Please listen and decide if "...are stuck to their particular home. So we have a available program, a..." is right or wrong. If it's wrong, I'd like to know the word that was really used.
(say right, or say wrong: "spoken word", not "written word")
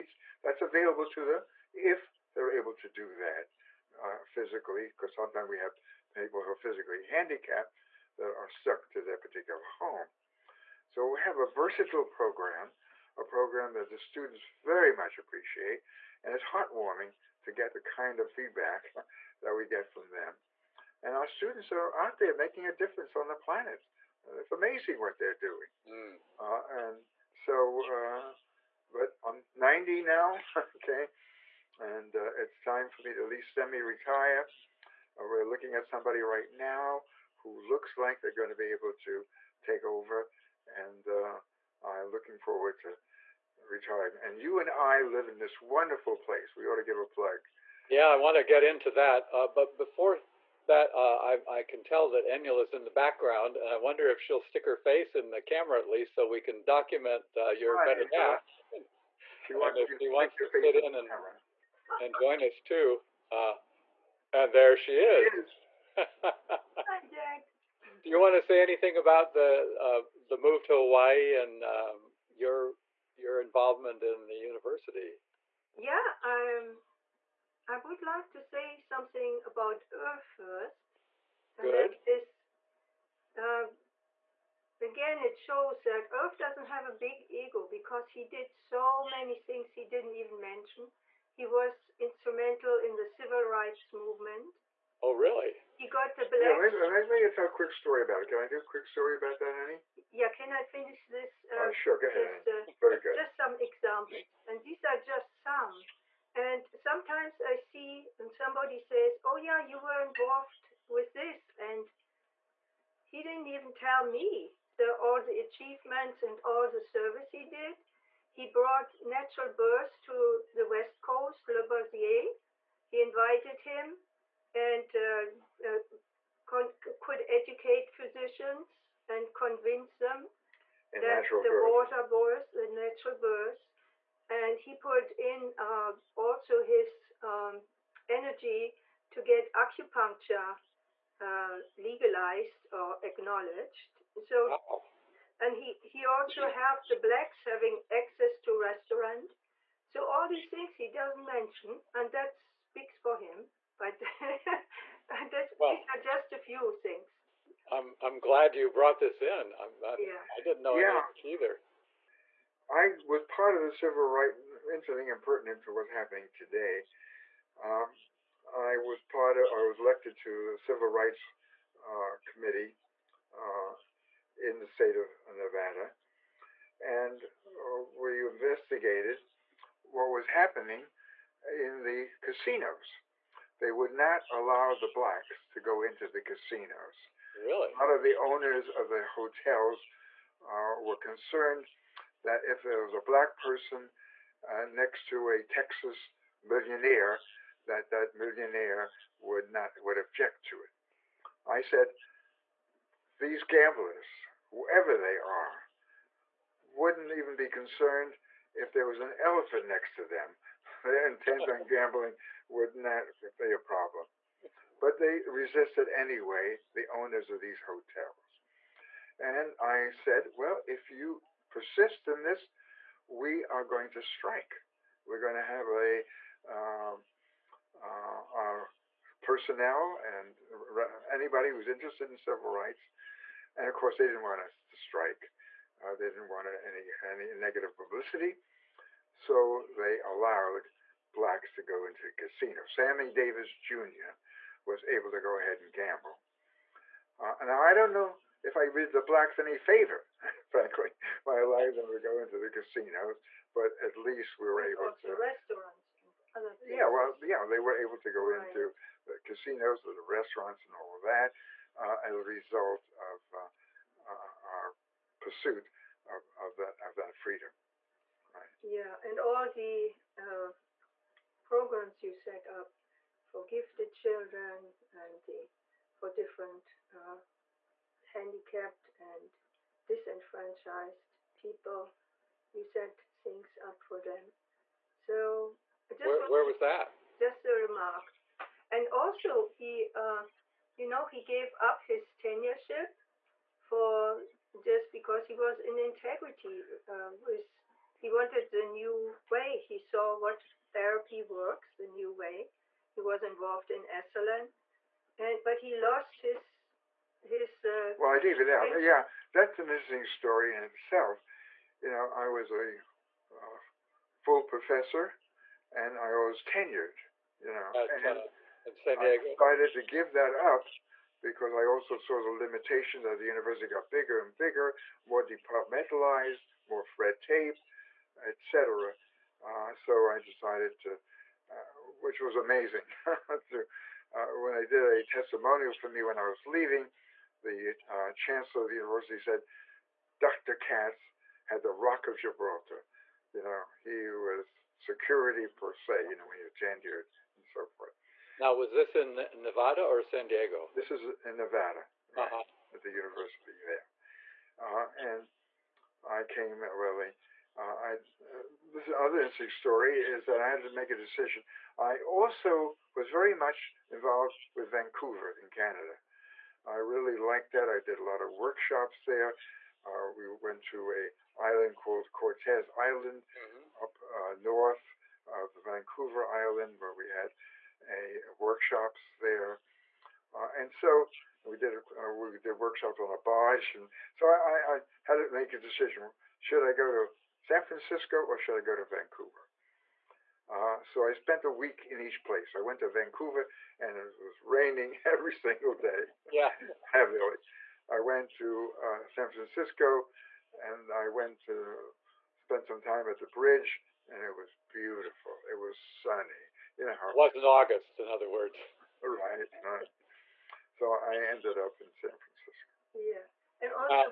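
wrong: "versatile", not "available".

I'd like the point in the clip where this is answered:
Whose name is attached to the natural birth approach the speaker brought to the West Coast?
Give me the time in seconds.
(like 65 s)
121 s.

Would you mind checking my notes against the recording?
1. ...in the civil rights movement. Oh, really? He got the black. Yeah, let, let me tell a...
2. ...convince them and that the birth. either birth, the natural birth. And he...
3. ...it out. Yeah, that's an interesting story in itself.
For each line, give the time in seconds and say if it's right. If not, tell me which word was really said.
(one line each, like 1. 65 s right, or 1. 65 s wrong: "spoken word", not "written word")
1. 92 s right
2. 129 s wrong: "water", not "either"
3. 308 s right.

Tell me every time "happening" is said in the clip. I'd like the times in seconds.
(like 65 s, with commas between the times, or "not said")
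165 s, 180 s.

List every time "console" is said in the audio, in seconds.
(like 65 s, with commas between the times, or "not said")
not said.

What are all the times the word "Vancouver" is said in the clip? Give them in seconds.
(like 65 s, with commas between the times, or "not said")
364 s, 375 s, 388 s, 392 s.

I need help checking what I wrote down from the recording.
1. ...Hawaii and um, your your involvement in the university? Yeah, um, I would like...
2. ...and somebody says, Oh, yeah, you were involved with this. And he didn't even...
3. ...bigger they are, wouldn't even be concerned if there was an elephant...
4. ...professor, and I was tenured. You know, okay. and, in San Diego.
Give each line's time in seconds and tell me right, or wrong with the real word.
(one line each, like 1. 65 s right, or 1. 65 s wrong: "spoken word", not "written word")
1. 70 s right
2. 108 s right
3. 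204 s wrong: "whoever", not "bigger"
4. 314 s right.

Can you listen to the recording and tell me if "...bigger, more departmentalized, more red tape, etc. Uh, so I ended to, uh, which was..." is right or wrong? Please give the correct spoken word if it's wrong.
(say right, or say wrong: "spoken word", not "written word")
wrong: "decided", not "ended".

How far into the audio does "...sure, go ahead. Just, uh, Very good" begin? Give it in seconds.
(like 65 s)
101 s.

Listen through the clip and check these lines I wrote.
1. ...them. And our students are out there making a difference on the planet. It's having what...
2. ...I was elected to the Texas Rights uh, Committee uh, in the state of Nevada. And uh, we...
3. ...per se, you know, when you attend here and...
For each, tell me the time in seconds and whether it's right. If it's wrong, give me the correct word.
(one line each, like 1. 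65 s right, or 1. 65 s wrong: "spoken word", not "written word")
1. 20 s wrong: "amazing", not "having"
2. 169 s wrong: "Civil", not "Texas"
3. 345 s right.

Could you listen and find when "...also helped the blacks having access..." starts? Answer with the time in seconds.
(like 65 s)
146 s.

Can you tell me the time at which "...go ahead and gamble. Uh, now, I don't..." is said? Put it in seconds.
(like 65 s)
245 s.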